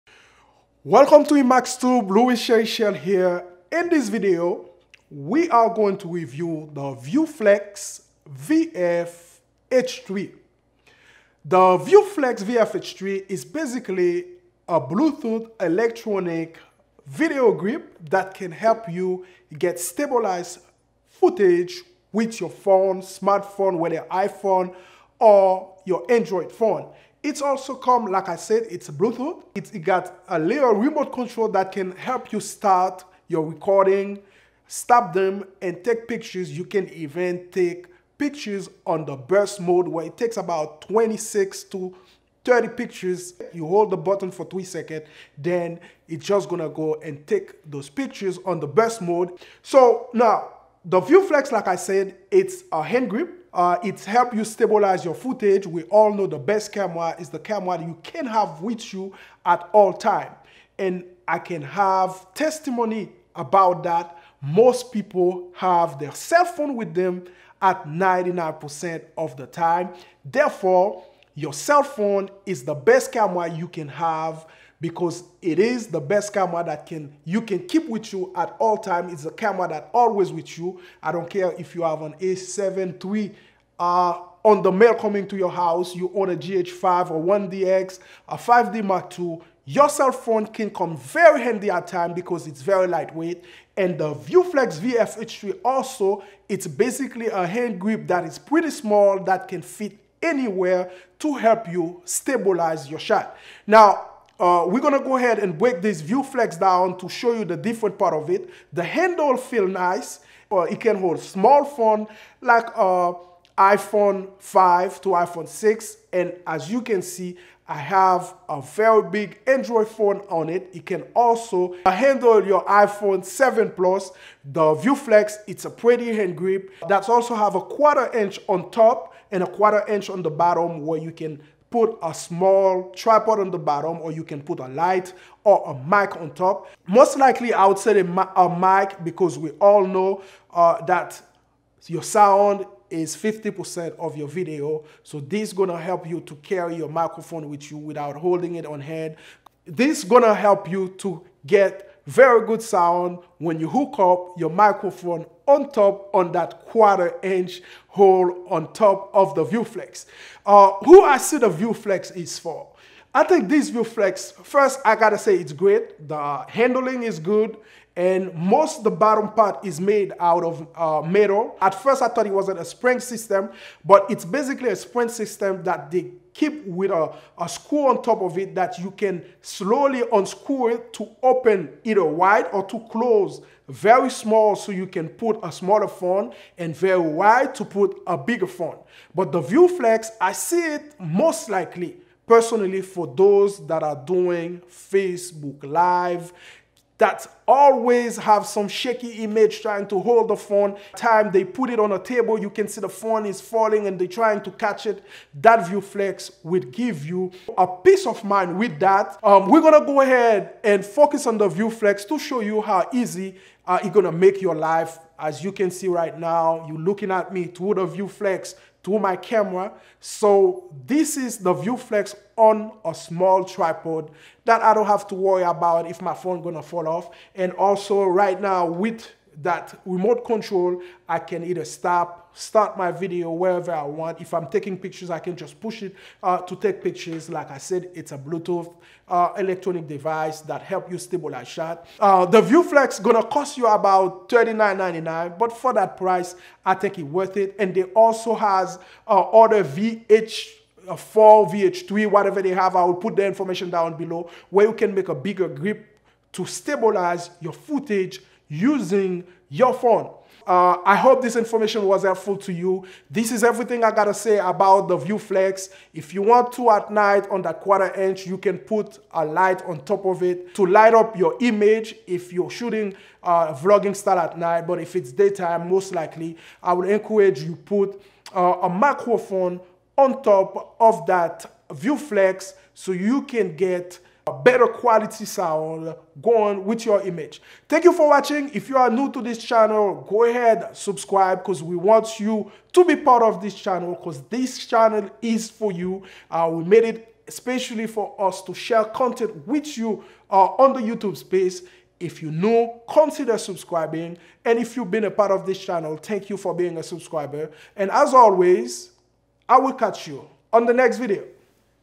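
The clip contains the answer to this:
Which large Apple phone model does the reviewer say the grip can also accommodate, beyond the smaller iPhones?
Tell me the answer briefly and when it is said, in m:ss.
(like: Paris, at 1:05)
iPhone 7 Plus, at 2:02.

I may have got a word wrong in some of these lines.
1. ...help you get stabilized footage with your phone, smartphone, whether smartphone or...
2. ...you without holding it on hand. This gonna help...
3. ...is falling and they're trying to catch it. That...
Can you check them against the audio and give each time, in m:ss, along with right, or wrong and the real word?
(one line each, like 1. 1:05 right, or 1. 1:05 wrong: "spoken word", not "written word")
1. 0:18 wrong: "iPhone", not "smartphone"
2. 2:27 right
3. 3:23 right.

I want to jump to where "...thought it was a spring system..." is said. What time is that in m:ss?
2:52.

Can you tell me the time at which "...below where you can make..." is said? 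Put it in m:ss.
4:13.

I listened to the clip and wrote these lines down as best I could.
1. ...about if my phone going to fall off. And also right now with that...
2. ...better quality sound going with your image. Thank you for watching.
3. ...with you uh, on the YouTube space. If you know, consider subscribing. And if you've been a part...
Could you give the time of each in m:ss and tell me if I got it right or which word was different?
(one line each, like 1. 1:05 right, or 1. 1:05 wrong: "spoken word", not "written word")
1. 3:45 right
2. 4:44 right
3. 4:59 right.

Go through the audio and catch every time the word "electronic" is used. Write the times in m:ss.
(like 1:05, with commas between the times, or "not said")
0:15, 3:59.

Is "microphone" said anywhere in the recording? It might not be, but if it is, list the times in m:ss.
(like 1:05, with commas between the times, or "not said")
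2:26, 2:34, 4:38.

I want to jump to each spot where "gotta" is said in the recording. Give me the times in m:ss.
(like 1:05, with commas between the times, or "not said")
2:44, 4:23.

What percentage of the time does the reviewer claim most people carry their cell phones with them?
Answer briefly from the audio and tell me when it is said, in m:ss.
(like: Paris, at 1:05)
99%, at 1:07.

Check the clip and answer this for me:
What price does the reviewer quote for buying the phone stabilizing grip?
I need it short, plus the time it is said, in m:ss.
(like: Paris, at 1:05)
$39.99, at 4:04.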